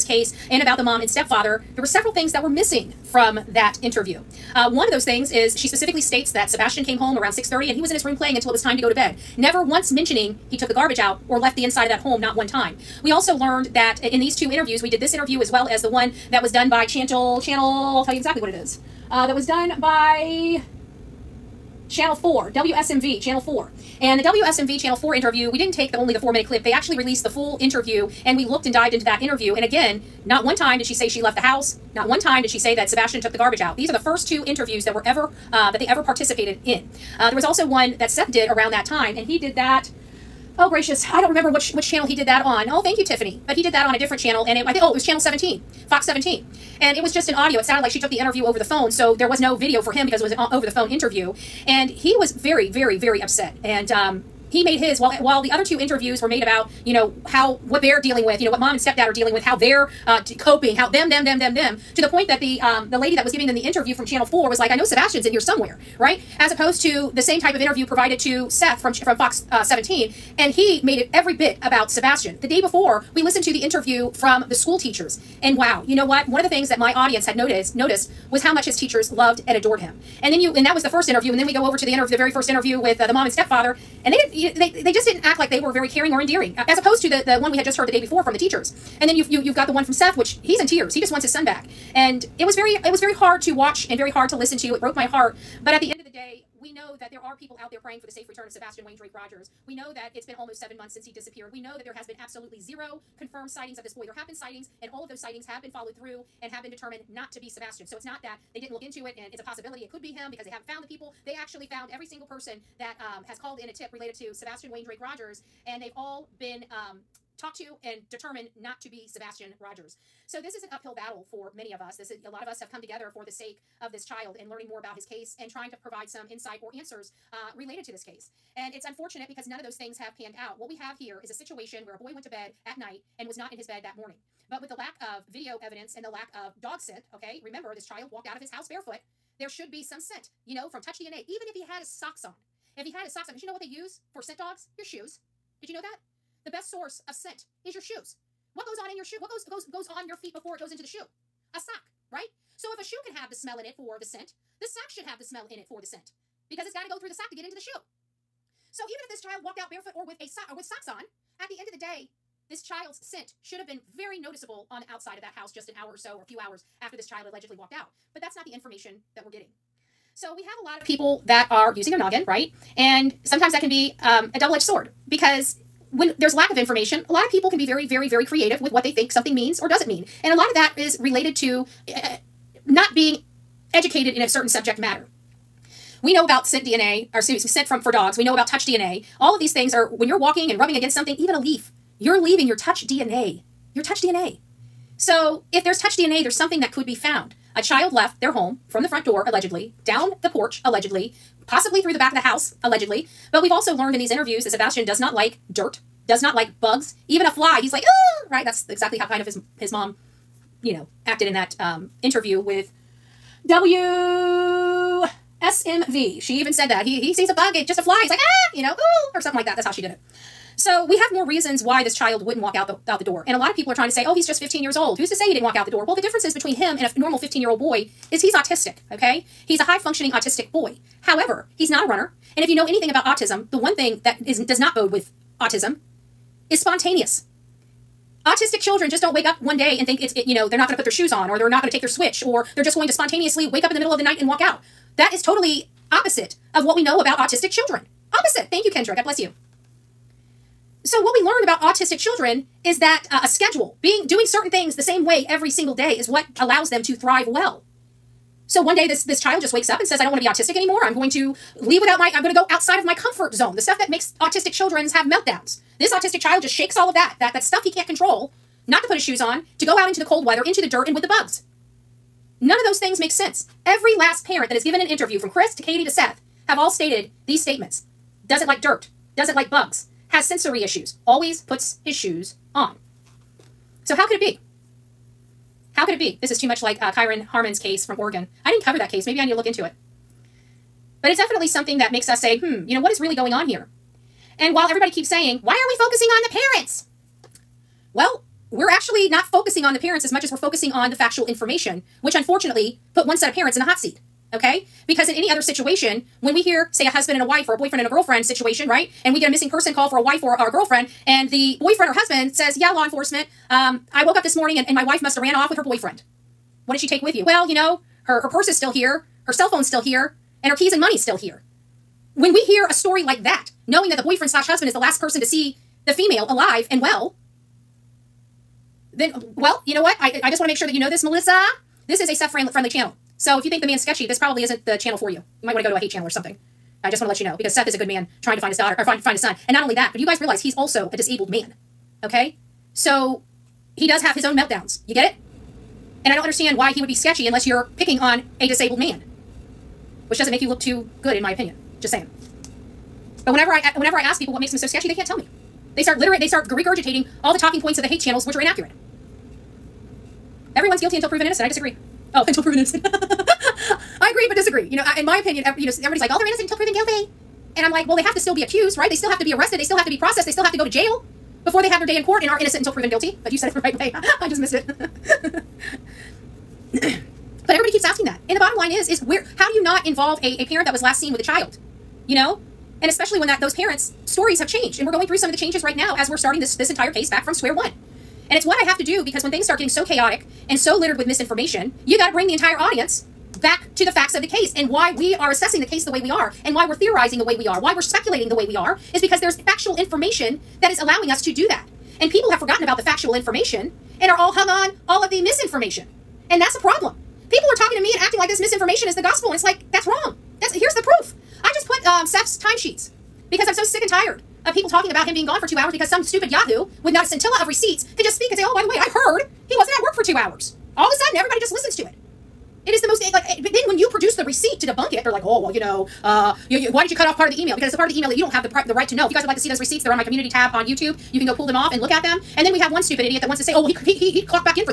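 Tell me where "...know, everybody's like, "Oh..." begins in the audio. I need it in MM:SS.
06:05.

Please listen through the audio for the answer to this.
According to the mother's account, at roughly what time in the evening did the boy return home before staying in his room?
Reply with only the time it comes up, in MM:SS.
00:07.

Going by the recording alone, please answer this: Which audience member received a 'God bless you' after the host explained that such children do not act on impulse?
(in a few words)
Kendra.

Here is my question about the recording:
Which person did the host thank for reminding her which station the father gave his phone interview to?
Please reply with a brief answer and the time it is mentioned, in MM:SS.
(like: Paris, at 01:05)
Tiffany, at 00:43.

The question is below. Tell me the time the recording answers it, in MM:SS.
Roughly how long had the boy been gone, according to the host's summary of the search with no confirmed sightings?
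01:40.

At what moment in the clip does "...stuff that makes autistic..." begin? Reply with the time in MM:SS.
04:23.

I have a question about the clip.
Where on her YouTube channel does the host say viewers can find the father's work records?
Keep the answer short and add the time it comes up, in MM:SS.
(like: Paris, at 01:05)
Community tab, at 07:10.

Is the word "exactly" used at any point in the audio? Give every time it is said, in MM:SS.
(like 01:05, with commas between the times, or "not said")
00:18, 03:28.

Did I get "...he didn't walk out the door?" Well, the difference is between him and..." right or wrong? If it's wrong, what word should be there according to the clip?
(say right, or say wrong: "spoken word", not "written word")
right.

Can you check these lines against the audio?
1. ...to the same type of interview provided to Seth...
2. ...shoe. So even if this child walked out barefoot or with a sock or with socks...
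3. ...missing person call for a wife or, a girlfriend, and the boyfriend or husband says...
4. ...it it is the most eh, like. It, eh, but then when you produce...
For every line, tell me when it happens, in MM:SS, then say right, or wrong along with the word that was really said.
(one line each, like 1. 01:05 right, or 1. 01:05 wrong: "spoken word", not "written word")
1. 01:06 right
2. 02:37 right
3. 05:09 right
4. 07:01 right.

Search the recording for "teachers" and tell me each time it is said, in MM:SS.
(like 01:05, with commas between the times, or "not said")
01:14, 01:18, 01:28.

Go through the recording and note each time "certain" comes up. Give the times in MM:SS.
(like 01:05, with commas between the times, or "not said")
03:04, 04:14.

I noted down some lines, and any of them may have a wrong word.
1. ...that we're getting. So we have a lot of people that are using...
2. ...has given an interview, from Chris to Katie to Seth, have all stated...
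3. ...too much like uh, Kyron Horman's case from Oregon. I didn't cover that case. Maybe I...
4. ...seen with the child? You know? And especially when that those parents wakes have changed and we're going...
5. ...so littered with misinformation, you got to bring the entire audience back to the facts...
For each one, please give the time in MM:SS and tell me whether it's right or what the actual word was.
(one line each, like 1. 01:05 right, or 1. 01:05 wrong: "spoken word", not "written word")
1. 02:49 right
2. 04:34 right
3. 04:46 right
4. 06:20 wrong: "stories", not "wakes"
5. 06:30 right.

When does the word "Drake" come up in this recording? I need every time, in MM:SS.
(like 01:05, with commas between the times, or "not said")
01:38, 01:54.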